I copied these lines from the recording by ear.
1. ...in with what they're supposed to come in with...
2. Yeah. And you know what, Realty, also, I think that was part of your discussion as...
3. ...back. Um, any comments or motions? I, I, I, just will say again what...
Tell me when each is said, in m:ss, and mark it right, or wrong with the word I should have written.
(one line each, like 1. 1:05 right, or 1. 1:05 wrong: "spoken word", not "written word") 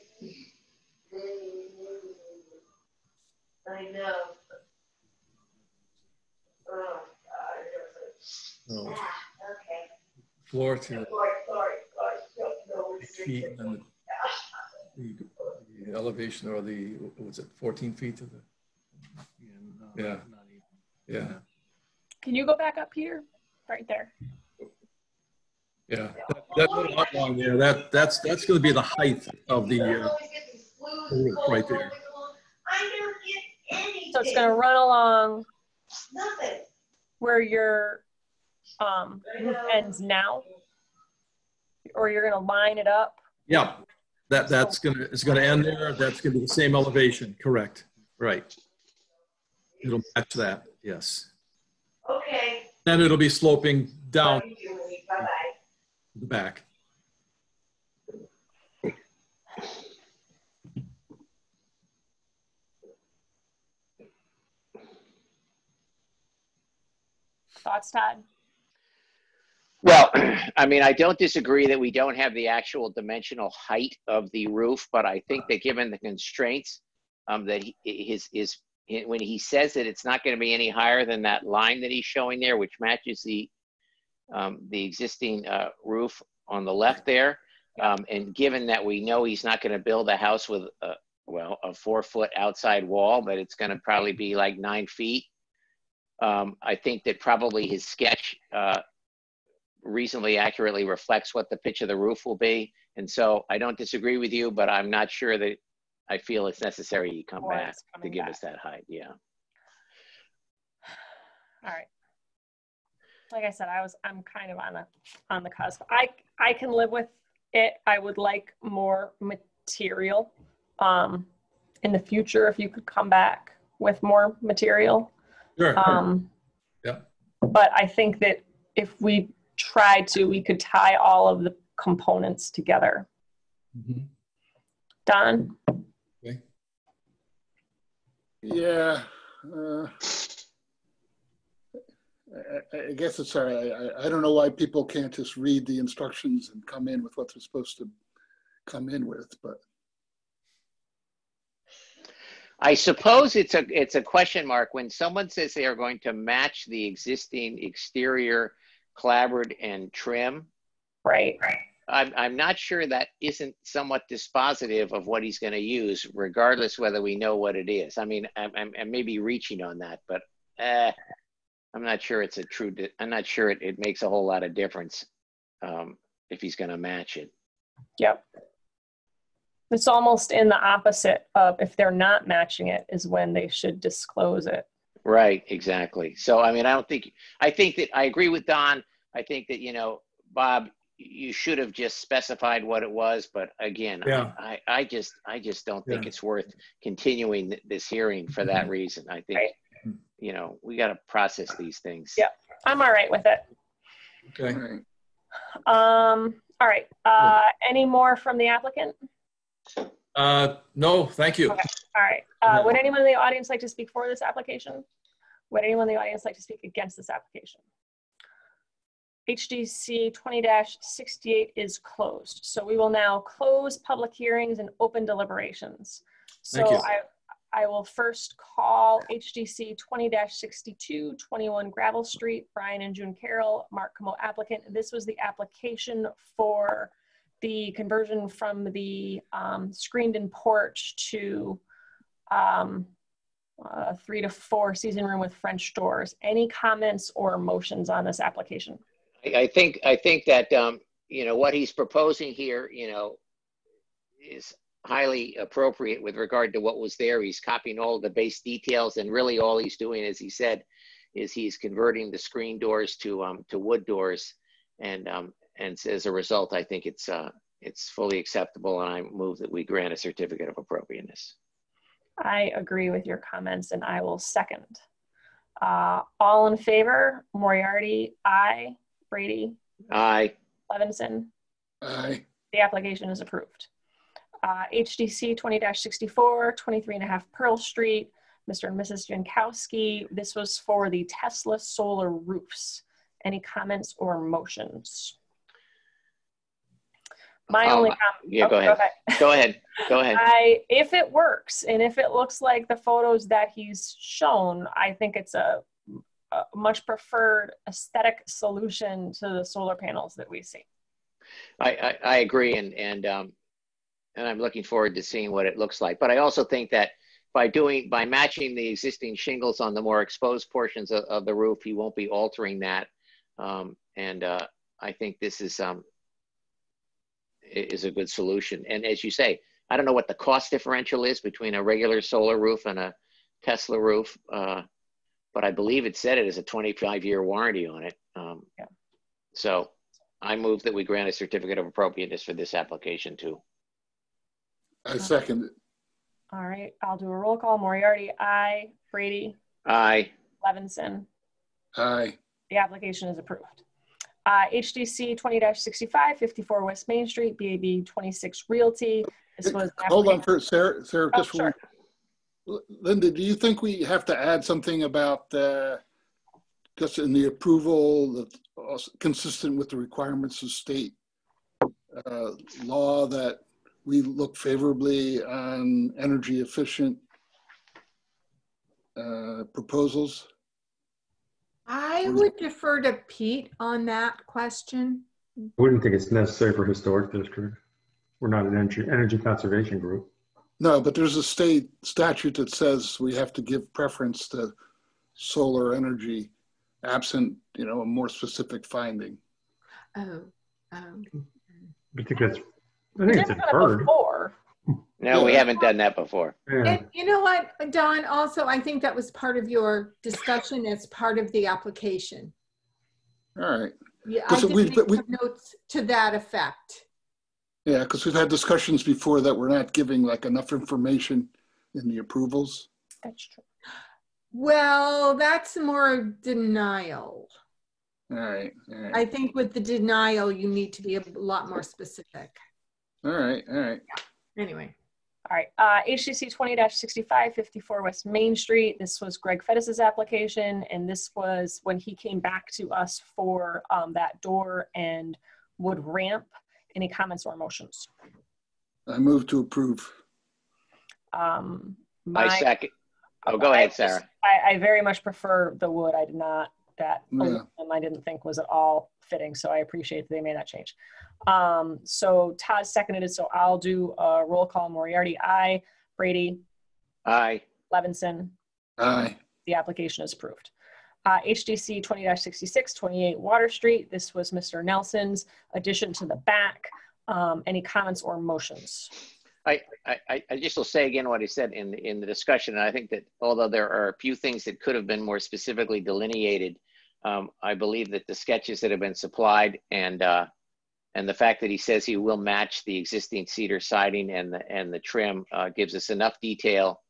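1. 2:26 right
2. 6:46 wrong: "Don", not "Realty"
3. 7:56 right.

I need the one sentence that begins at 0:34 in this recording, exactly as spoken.
So it's going to run along where your um, ends now, or you're going to line it up.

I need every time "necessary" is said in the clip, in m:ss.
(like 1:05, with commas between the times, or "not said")
1:46, 6:26.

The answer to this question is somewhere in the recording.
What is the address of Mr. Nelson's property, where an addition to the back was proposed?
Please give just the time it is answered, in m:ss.
7:52.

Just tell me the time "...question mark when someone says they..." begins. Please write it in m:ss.
2:34.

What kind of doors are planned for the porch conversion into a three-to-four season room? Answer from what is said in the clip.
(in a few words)
French doors.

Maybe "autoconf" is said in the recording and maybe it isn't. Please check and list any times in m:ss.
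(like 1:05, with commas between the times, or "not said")
not said.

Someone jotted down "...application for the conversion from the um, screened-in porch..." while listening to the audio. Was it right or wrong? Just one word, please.
right.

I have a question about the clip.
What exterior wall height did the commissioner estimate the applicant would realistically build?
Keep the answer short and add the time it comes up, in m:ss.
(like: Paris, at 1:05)
9 feet, at 1:34.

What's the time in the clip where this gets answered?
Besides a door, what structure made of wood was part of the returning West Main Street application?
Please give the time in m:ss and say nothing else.
7:25.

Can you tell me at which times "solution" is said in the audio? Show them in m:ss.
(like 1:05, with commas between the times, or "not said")
5:08, 5:28.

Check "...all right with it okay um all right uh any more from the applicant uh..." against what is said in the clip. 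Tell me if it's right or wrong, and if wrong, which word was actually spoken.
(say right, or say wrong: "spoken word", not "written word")
right.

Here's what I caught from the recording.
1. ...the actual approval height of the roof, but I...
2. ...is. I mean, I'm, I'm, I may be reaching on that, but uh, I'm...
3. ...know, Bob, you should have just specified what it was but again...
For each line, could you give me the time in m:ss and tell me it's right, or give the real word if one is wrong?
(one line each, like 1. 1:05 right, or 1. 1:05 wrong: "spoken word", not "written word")
1. 1:12 wrong: "dimensional", not "approval"
2. 2:47 right
3. 3:09 right.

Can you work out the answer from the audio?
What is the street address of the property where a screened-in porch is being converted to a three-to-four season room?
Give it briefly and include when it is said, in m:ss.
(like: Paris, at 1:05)
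21 Gravel Street, at 3:51.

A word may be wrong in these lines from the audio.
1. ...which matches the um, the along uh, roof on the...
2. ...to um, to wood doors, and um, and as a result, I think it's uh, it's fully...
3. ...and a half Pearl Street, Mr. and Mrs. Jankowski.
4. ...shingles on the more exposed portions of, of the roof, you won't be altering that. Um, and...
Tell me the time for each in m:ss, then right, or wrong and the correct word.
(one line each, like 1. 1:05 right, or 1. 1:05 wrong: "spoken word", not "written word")
1. 1:22 wrong: "existing", not "along"
2. 4:22 right
3. 4:46 right
4. 5:19 right.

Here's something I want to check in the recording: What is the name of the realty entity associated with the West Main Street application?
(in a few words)
BAB 26 Realty.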